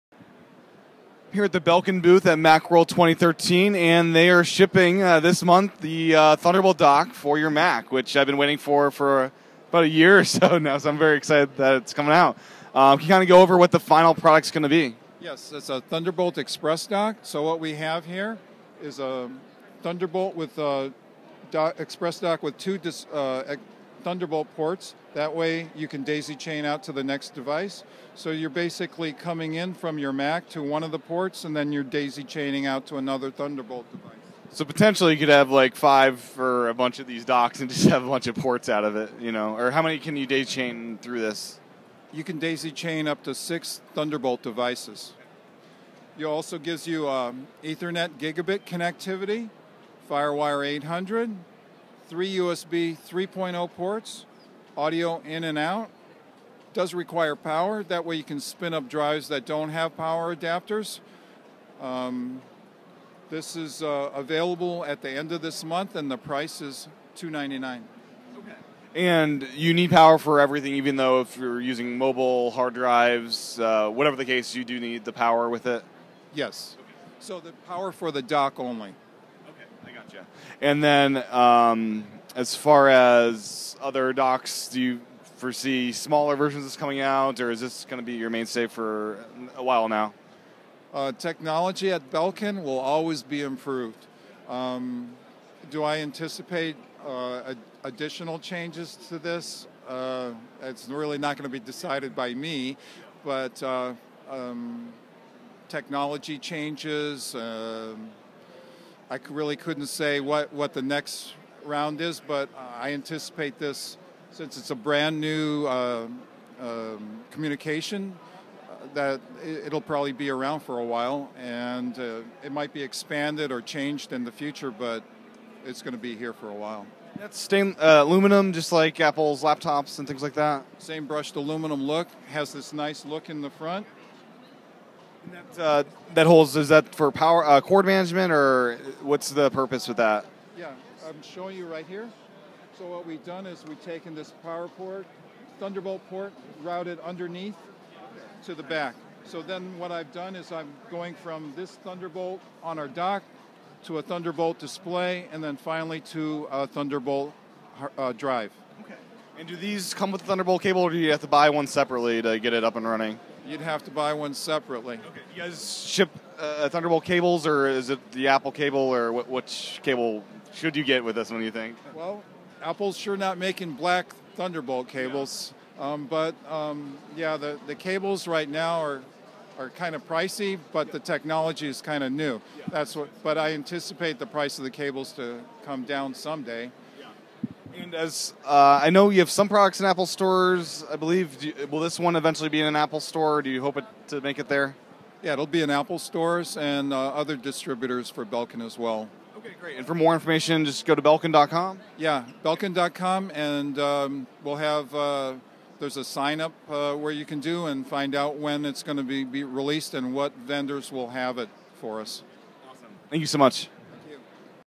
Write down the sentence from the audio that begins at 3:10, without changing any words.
I believe you, will this one eventually be in an Apple store?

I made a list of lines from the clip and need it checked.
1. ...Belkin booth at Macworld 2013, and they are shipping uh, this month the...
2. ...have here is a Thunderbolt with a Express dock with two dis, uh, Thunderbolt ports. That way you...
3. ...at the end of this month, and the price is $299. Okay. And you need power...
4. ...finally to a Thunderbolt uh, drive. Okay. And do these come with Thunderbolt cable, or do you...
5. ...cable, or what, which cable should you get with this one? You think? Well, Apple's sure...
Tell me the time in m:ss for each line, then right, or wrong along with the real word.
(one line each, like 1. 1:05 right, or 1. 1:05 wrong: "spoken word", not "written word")
1. 0:01 right
2. 0:17 right
3. 1:04 right
4. 2:35 right
5. 2:48 right.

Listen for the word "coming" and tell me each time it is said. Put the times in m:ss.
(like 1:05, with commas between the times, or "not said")
0:11, 0:29, 1:26.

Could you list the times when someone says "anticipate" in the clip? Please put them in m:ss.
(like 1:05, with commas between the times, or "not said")
1:35, 1:52, 3:03.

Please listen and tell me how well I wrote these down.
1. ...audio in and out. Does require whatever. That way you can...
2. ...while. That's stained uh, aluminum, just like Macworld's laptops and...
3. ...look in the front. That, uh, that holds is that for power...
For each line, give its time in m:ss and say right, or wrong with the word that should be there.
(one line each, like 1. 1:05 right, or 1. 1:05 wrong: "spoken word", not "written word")
1. 0:54 wrong: "power", not "whatever"
2. 2:06 wrong: "Apple", not "Macworld"
3. 2:13 right.